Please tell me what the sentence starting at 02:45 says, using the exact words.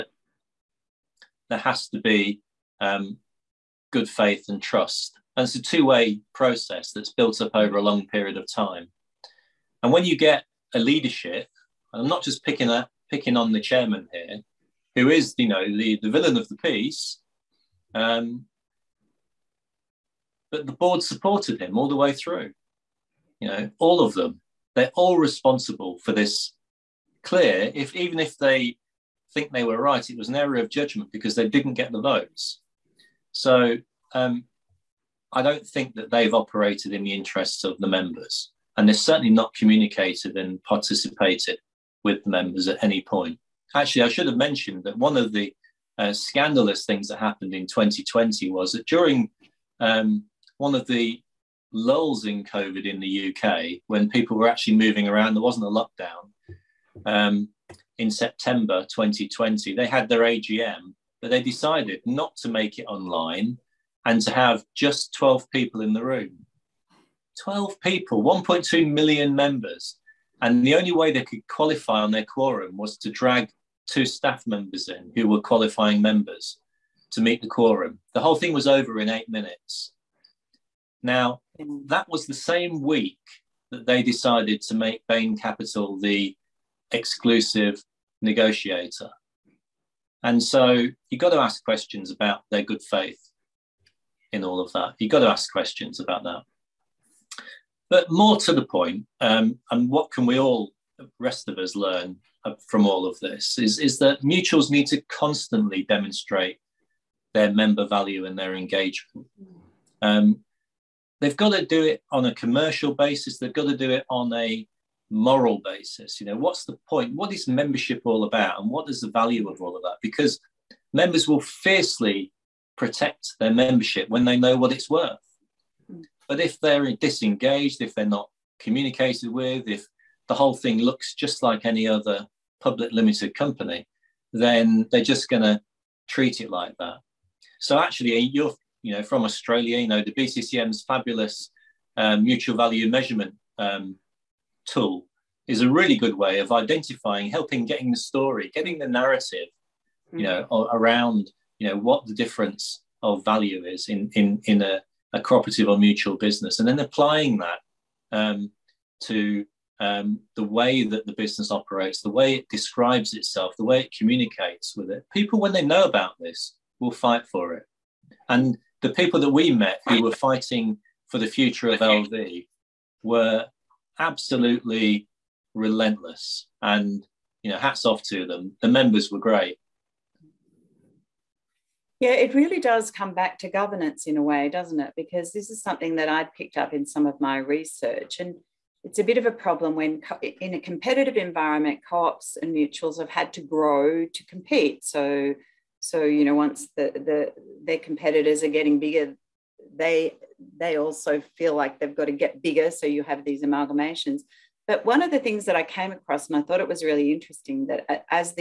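People, when they know about this, will fight for it.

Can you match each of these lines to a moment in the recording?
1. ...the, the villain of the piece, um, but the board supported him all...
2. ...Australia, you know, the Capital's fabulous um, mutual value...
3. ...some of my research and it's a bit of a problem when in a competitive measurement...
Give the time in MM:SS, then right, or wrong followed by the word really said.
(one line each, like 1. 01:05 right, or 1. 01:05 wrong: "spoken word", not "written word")
1. 00:15 right
2. 02:19 wrong: "BCCM", not "Capital"
3. 03:06 wrong: "environment", not "measurement".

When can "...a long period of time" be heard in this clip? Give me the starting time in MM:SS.
00:07.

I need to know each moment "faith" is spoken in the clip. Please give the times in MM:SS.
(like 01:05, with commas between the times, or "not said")
00:04, 01:32.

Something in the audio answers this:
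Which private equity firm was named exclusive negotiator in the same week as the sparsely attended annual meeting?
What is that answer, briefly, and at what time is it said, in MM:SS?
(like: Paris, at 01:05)
Bain Capital, at 01:25.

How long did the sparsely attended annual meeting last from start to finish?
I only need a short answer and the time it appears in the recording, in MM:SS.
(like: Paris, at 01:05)
8 minutes, at 01:19.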